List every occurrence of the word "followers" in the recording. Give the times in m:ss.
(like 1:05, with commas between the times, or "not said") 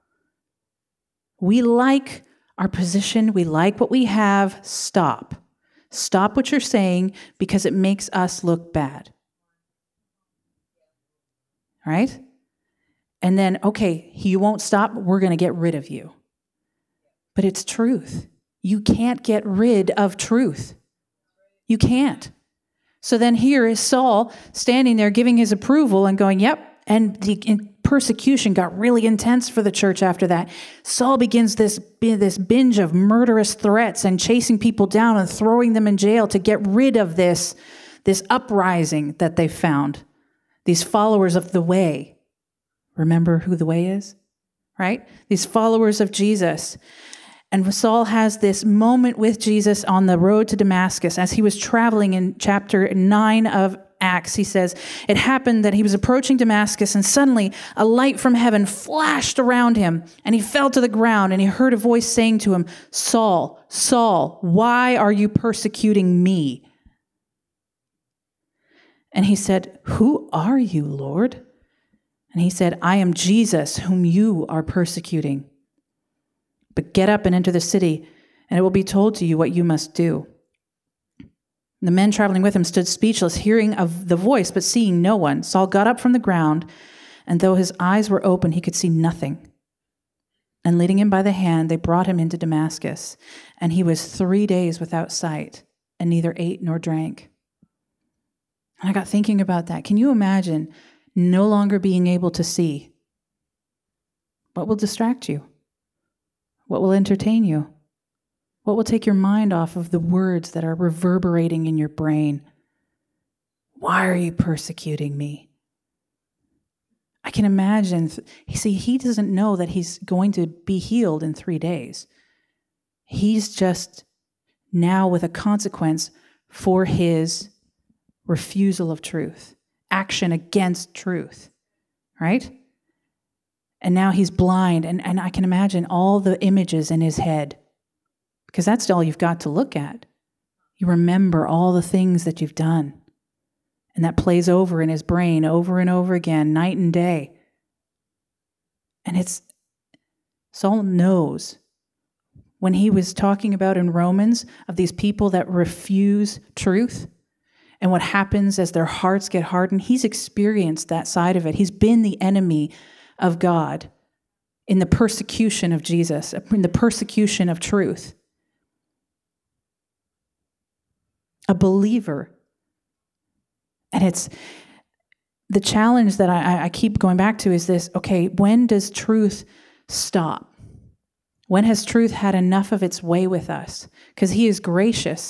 0:40, 0:45.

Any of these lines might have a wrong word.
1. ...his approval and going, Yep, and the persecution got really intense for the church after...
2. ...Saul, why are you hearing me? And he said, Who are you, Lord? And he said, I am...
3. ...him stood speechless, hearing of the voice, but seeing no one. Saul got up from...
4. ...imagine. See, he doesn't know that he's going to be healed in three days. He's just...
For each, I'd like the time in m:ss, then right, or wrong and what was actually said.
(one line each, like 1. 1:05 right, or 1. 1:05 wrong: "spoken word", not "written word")
1. 0:25 right
2. 1:03 wrong: "persecuting", not "hearing"
3. 1:22 right
4. 1:57 right.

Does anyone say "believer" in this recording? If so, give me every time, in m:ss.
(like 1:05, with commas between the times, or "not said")
2:51.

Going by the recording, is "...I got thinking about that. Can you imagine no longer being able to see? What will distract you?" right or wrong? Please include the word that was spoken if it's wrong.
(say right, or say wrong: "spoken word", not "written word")
right.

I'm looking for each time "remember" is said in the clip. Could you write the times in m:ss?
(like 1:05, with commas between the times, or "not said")
0:42, 2:20.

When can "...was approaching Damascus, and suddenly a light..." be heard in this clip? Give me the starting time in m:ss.
0:55.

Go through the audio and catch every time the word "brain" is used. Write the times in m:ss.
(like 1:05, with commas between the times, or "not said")
1:51, 2:25.